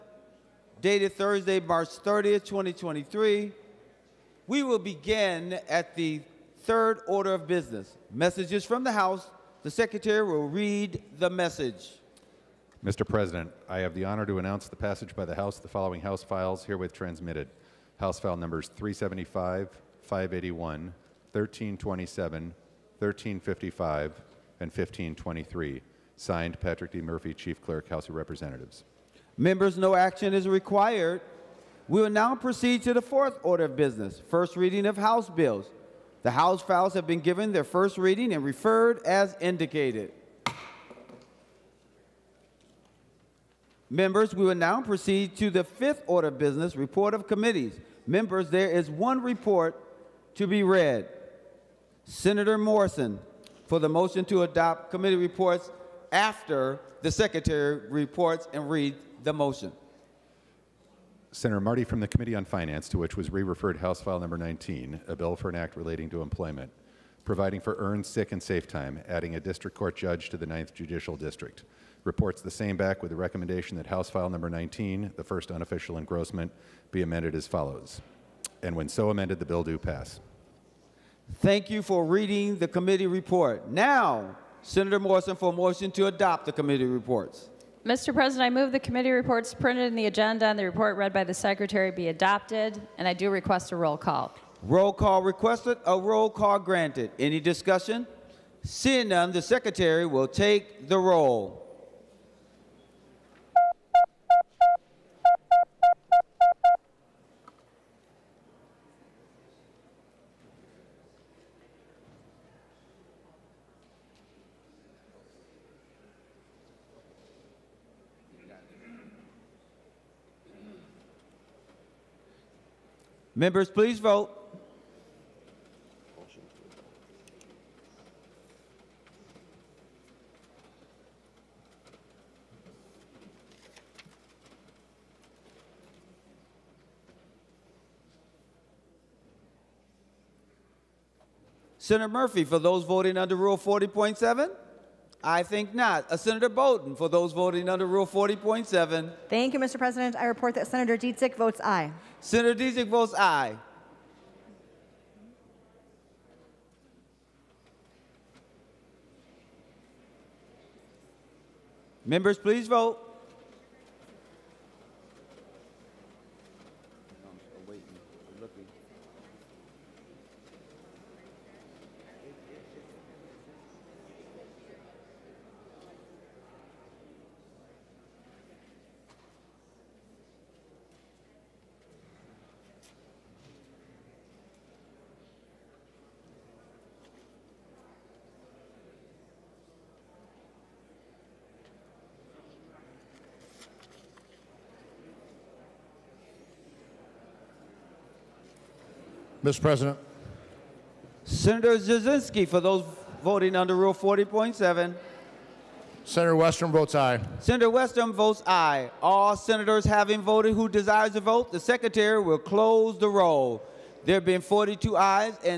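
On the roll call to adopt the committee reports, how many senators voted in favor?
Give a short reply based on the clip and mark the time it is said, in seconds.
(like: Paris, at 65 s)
42, at 214 s.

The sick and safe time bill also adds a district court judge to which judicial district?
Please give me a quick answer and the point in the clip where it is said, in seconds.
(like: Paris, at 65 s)
Ninth Judicial District, at 70 s.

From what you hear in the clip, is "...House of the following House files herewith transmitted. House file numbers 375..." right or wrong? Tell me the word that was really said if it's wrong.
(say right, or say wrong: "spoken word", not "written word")
right.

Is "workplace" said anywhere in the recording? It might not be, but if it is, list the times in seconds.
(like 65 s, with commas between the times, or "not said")
not said.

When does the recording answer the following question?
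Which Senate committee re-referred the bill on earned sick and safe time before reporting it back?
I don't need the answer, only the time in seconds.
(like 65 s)
62 s.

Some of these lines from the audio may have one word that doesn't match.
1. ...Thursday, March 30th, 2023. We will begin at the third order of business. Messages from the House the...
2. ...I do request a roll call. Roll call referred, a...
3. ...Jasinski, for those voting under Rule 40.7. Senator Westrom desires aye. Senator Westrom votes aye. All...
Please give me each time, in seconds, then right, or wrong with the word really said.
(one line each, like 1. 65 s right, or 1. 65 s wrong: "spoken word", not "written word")
1. 1 s right
2. 93 s wrong: "requested", not "referred"
3. 201 s wrong: "votes", not "desires".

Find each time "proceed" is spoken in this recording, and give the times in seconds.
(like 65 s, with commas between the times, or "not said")
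32 s, 44 s.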